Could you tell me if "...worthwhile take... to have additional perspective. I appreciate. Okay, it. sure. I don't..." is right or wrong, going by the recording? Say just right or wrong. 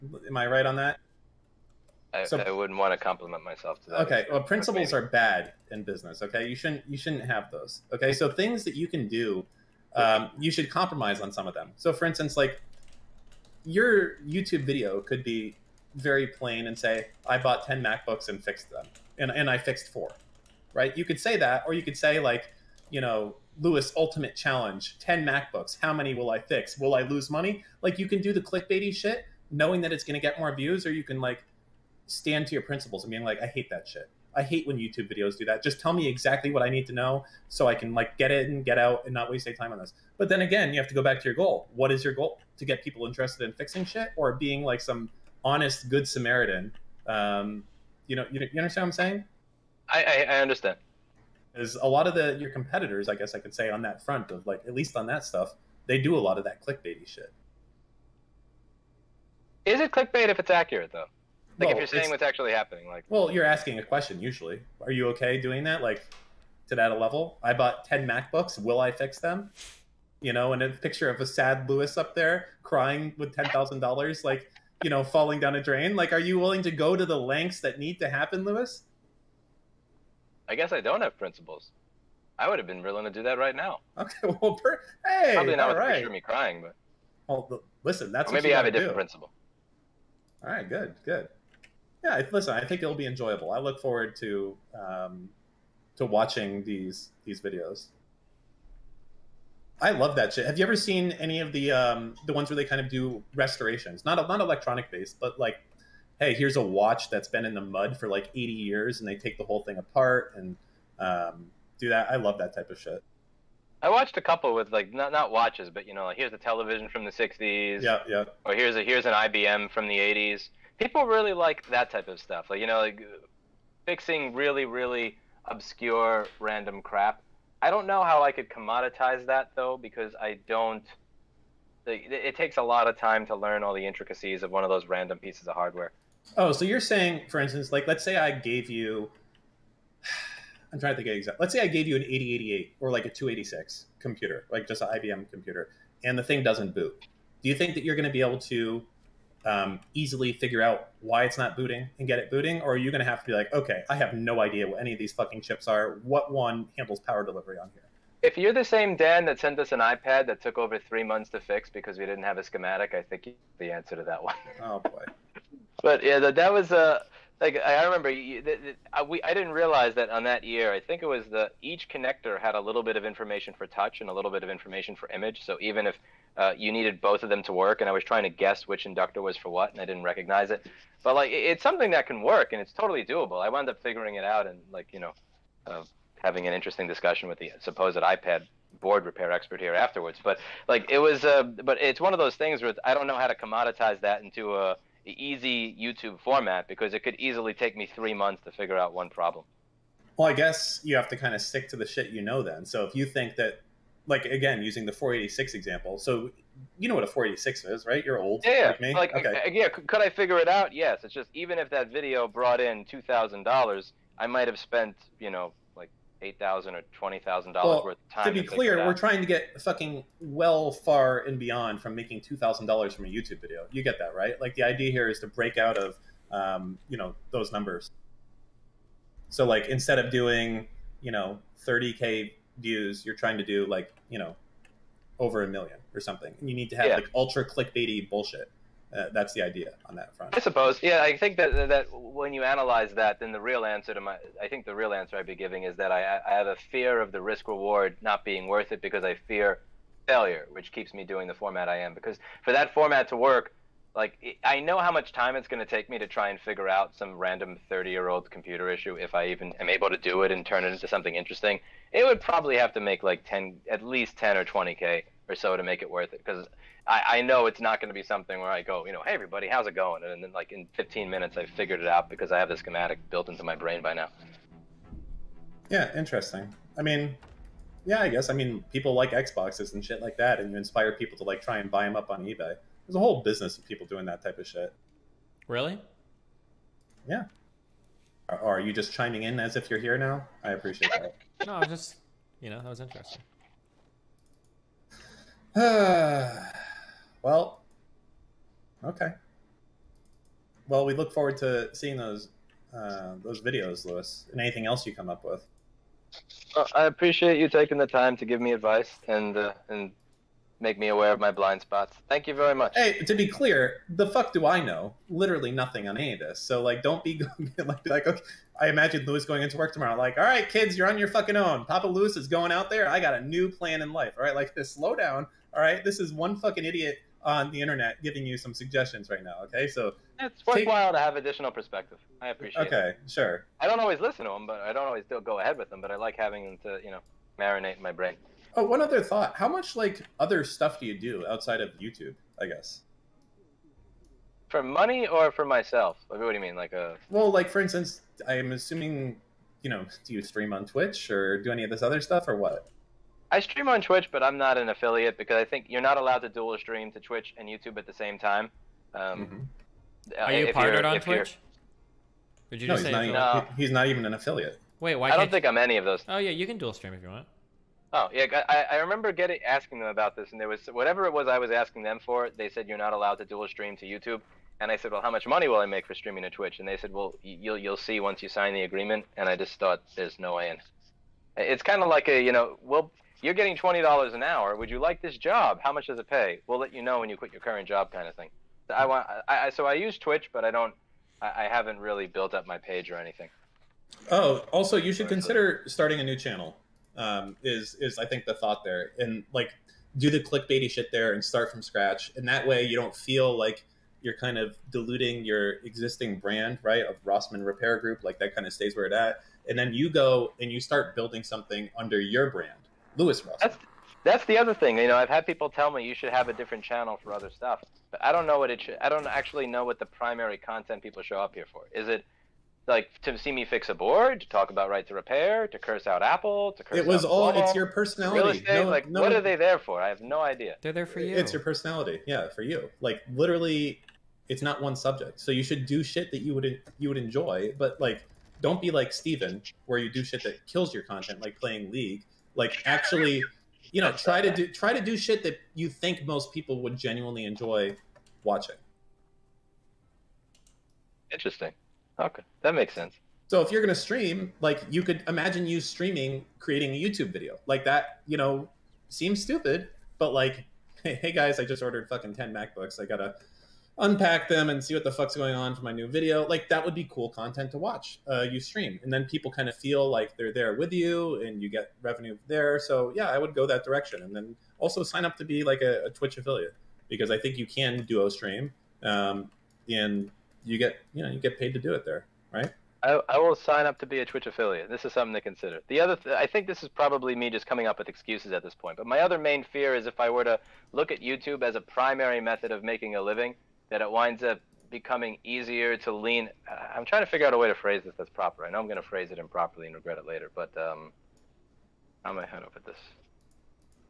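right.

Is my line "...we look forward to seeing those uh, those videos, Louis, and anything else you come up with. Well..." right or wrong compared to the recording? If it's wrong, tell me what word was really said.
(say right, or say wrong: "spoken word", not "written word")
right.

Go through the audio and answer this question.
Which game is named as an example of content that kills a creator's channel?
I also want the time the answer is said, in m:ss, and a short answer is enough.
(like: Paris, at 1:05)
League, at 7:21.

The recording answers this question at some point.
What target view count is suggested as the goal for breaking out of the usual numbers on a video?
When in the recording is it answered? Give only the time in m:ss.
3:55.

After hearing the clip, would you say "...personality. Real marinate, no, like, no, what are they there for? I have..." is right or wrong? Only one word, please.
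wrong.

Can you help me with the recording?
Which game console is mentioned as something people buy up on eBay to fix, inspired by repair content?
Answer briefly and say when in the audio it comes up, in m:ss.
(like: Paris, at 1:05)
Xboxes, at 4:39.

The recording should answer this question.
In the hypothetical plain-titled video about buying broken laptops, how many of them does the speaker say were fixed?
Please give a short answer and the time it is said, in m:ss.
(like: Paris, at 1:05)
4, at 0:19.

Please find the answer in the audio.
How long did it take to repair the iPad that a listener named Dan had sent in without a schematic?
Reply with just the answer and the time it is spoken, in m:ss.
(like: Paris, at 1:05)
over three months, at 2:40.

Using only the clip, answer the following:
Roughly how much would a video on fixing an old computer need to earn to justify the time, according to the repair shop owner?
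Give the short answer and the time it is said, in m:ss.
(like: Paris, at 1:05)
10 or 20k, at 4:24.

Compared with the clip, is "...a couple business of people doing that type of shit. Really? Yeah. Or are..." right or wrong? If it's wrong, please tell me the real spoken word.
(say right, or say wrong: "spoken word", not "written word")
wrong: "whole", not "couple".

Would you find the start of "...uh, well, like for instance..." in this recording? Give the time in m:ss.
5:46.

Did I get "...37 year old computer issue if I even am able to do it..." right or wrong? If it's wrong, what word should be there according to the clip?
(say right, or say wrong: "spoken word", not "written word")
wrong: "30", not "37".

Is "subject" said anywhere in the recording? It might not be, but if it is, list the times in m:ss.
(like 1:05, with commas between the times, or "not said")
7:14.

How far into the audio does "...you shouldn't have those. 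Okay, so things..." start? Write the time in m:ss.
0:06.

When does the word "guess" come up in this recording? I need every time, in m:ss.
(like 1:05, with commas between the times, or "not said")
0:53, 1:20, 2:58, 3:20, 4:38, 5:42.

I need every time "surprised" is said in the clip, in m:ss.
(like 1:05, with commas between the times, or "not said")
not said.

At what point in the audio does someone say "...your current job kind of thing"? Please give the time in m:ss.
6:27.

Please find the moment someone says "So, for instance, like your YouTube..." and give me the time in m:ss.
0:11.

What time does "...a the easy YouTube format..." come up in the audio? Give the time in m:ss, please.
3:14.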